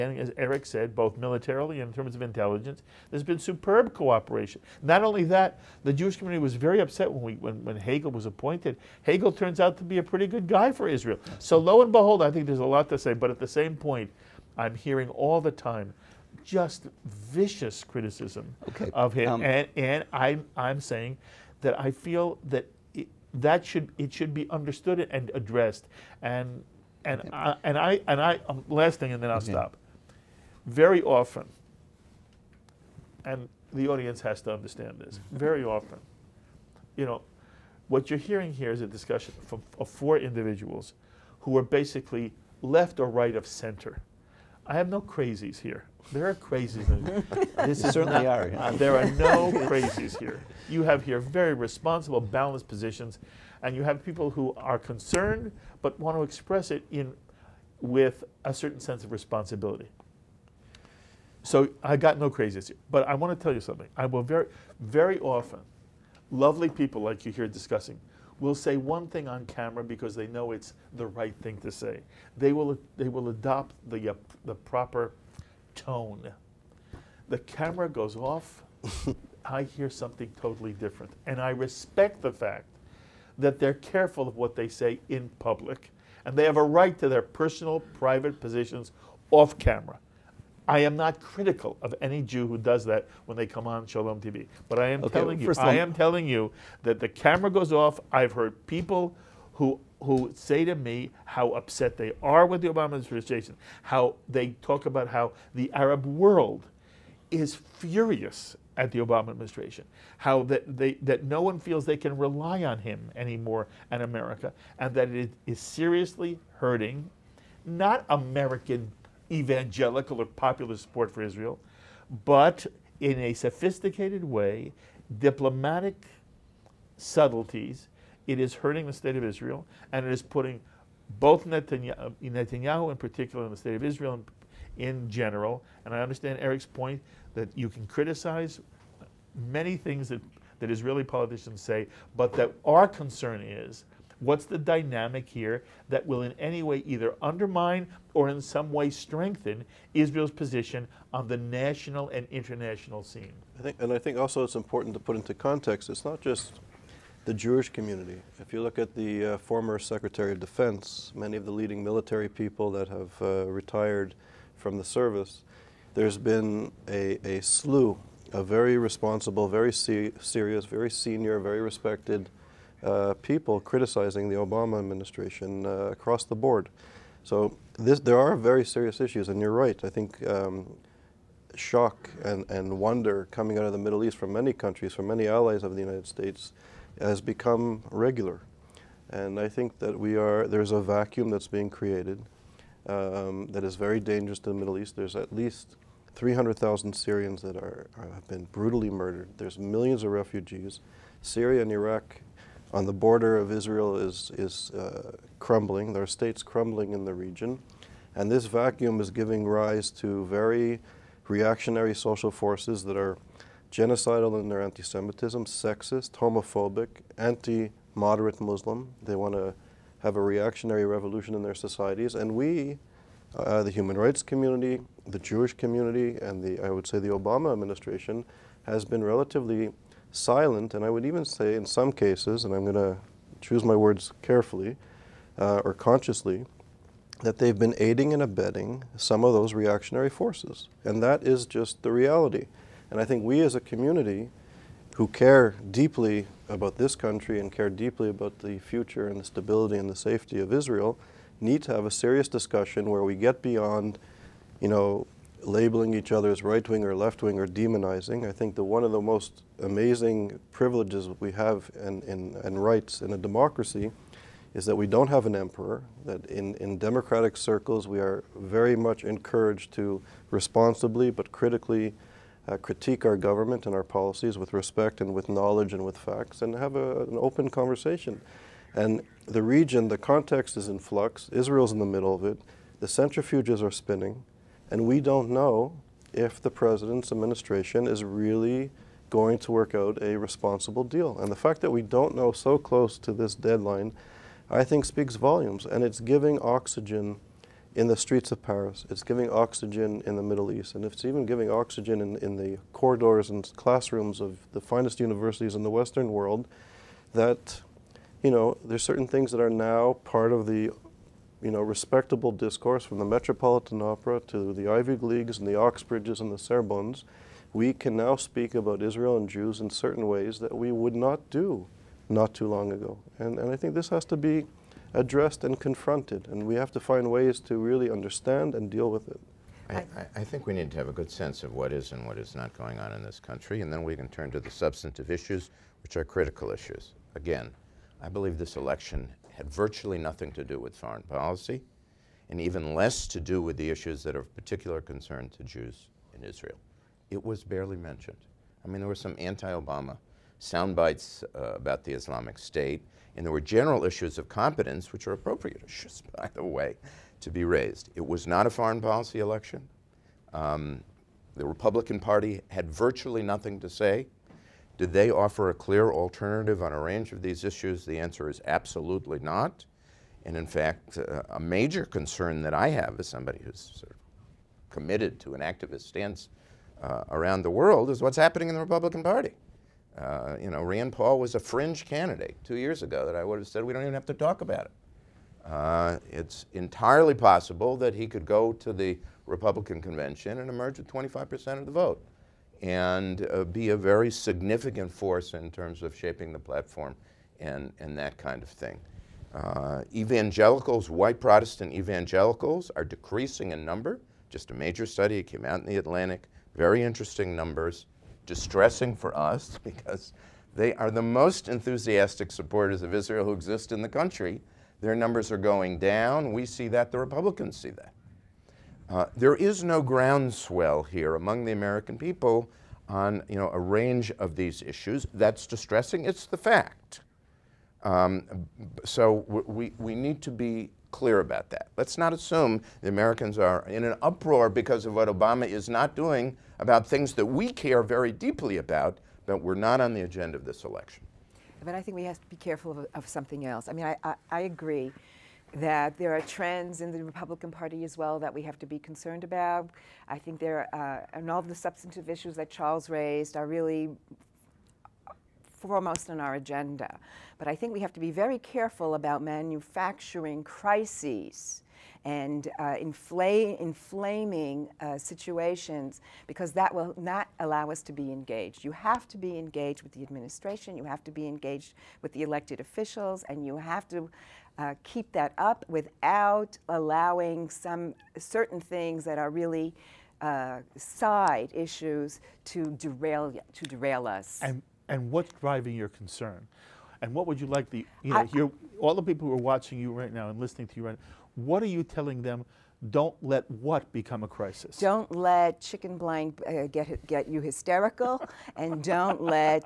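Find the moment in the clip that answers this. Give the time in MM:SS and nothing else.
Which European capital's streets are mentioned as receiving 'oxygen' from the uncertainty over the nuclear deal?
04:58.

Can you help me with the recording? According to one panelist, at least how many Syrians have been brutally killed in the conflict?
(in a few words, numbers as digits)
300,000.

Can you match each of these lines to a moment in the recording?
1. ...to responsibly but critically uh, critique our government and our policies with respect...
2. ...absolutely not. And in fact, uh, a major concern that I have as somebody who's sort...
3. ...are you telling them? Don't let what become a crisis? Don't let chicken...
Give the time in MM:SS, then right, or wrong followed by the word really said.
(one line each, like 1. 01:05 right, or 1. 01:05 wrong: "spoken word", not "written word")
1. 04:29 right
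2. 06:08 right
3. 08:11 right.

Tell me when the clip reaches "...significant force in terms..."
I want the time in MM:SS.
06:34.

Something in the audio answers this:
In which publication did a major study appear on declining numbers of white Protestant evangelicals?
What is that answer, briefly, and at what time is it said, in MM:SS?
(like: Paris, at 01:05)
The Atlantic, at 06:45.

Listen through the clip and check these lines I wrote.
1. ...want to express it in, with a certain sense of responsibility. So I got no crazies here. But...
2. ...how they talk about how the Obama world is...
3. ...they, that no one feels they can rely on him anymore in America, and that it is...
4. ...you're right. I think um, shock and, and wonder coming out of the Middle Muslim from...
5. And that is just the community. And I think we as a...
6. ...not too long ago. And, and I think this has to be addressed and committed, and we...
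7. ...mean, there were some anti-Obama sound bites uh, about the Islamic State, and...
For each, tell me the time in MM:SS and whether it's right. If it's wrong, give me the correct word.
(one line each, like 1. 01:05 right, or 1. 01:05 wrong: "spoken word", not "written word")
1. 00:55 right
2. 01:43 wrong: "Arab", not "Obama"
3. 01:50 right
4. 02:59 wrong: "East", not "Muslim"
5. 04:00 wrong: "reality", not "community"
6. 05:22 wrong: "confronted", not "committed"
7. 05:48 right.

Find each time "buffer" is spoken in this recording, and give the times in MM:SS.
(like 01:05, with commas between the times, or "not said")
not said.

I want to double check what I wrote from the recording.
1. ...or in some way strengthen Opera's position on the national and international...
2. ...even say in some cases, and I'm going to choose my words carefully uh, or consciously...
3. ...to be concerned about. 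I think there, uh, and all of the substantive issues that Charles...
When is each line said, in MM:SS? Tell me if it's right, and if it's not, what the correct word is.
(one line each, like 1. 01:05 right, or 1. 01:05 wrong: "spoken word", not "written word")
1. 02:28 wrong: "Israel", not "Opera"
2. 03:51 right
3. 07:28 right.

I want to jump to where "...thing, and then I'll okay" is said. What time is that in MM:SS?
00:28.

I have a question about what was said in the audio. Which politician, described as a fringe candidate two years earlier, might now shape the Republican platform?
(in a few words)
Rand Paul.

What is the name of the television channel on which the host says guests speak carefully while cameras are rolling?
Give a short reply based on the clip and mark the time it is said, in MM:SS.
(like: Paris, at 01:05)
Shalom TV, at 01:33.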